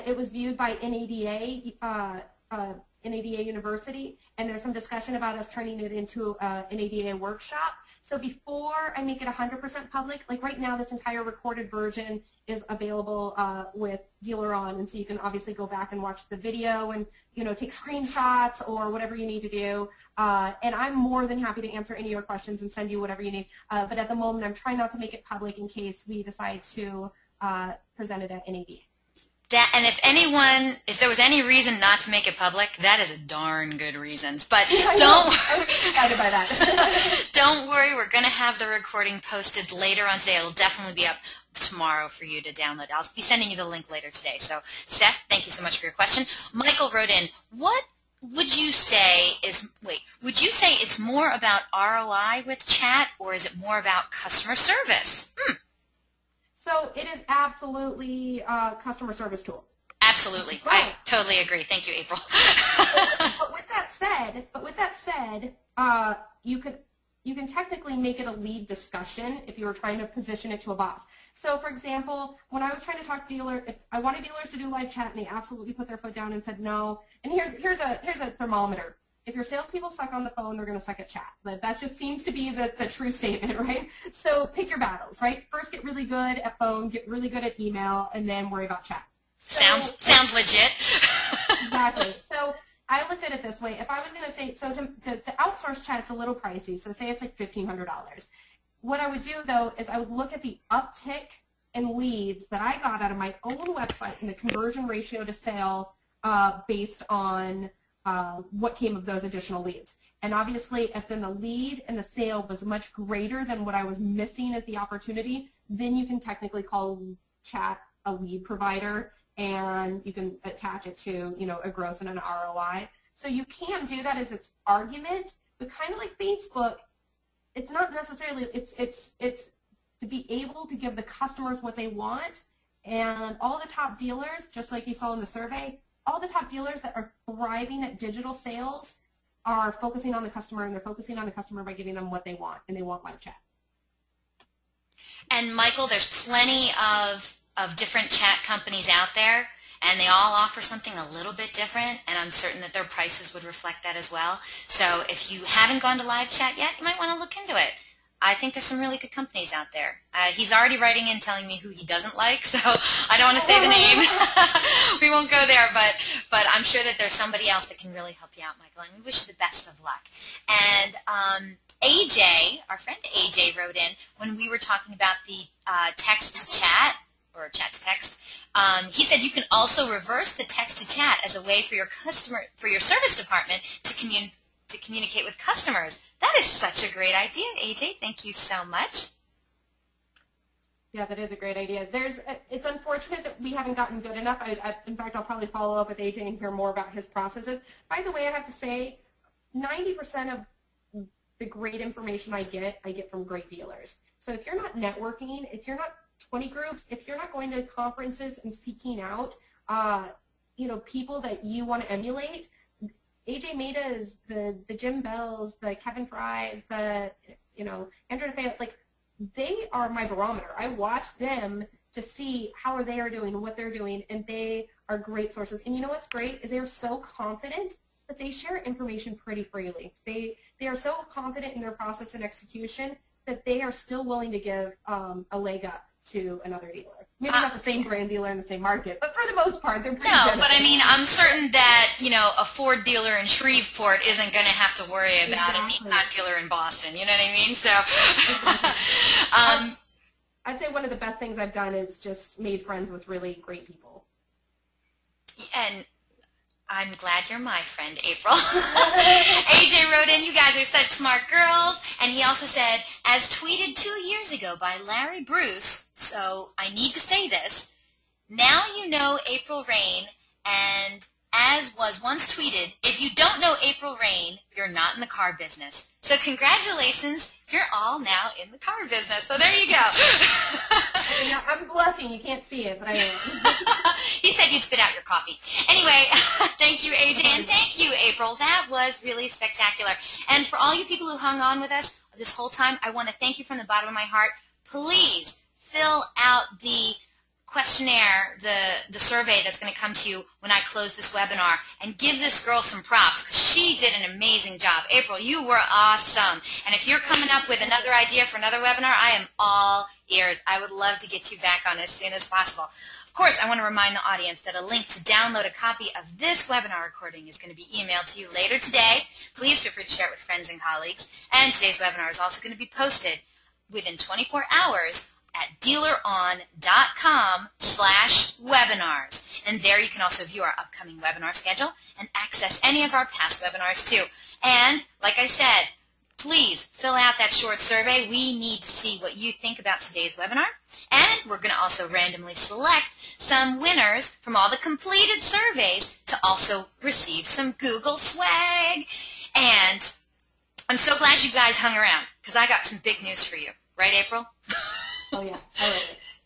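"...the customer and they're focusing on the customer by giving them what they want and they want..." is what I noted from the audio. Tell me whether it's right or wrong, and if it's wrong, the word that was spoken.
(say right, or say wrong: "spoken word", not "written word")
right.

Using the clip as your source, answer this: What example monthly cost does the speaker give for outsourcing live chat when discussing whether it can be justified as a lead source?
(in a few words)
$1,500.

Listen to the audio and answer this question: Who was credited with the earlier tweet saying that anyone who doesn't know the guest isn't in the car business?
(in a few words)
Larry Bruce.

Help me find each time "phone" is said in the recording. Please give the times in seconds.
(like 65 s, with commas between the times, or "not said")
80 s, 86 s.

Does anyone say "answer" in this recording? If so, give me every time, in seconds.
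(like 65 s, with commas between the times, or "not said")
21 s.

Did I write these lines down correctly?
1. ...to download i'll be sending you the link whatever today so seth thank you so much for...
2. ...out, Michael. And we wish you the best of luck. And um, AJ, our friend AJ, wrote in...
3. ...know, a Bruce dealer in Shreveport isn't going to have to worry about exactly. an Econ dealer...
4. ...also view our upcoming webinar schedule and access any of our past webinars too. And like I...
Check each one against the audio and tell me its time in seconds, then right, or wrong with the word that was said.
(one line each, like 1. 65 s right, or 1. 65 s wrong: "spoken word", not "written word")
1. 42 s wrong: "later", not "whatever"
2. 168 s right
3. 242 s wrong: "Ford", not "Bruce"
4. 330 s right.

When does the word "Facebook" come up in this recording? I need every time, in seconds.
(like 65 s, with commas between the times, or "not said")
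126 s.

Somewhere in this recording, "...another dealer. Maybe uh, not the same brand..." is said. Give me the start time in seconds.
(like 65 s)
236 s.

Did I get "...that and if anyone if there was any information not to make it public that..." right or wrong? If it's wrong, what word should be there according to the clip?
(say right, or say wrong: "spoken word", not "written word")
wrong: "reason", not "information".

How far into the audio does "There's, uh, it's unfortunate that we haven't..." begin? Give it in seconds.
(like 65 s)
191 s.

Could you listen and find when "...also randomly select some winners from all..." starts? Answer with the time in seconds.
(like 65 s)
341 s.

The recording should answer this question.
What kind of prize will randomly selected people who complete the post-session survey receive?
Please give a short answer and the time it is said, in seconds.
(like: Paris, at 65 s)
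Google swag, at 347 s.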